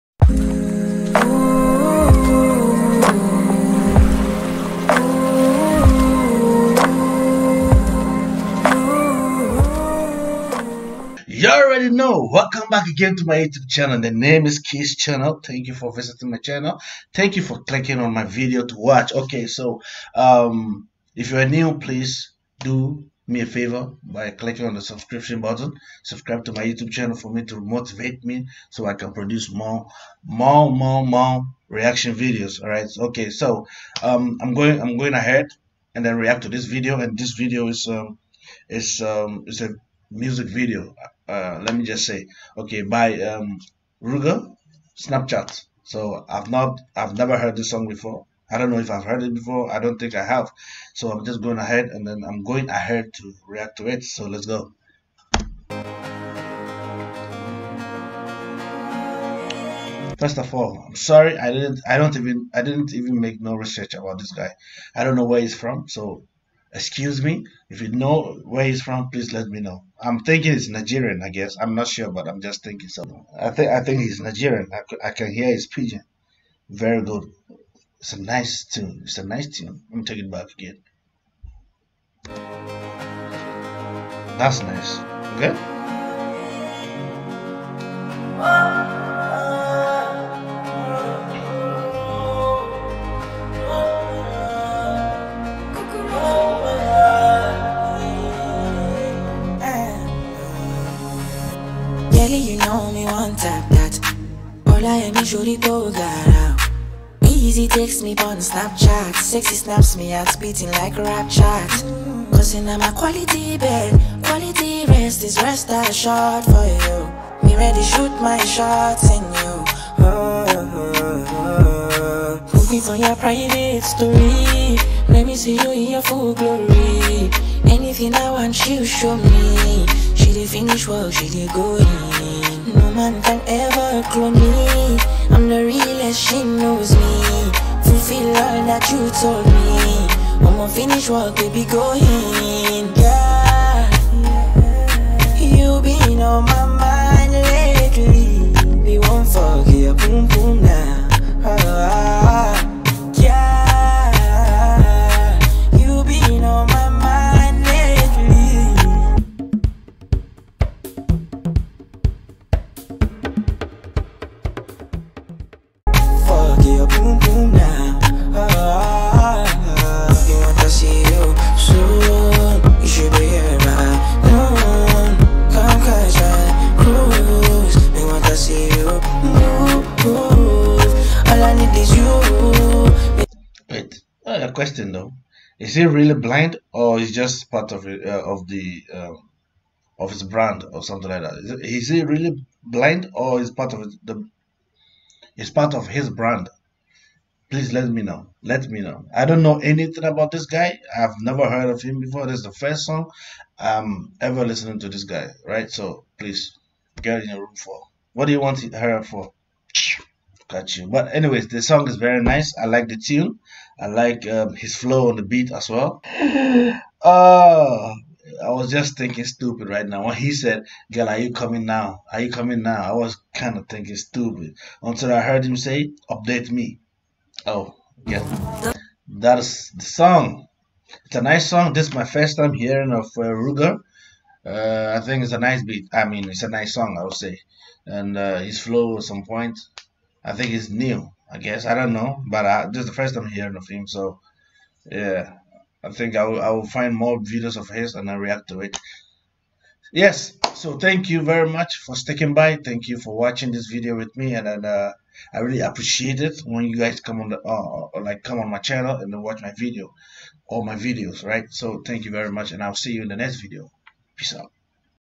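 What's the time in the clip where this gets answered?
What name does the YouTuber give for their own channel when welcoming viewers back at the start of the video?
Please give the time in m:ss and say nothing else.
0:14.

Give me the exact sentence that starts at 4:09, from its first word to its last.
Yes, so thank you very much for sticking by.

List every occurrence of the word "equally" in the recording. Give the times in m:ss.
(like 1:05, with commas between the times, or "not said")
not said.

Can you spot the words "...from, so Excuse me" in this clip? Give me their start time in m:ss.
1:05.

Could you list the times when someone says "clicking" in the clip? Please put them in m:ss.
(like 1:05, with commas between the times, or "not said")
0:17, 0:24.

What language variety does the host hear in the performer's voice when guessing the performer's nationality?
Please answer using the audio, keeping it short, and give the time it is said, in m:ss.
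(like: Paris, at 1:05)
Pidgin, at 1:15.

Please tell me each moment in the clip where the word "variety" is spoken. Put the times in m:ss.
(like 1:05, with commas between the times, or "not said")
not said.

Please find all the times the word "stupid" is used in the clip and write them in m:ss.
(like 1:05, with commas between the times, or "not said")
3:39, 3:43.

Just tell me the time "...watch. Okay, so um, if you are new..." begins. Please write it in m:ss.
0:18.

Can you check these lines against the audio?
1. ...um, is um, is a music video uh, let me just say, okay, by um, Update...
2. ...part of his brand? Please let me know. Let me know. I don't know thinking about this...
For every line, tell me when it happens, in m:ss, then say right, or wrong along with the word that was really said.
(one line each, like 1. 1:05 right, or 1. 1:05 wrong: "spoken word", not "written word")
1. 0:37 wrong: "Ruger", not "Update"
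2. 3:15 wrong: "anything", not "thinking".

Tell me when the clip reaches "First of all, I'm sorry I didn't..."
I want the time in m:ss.
1:00.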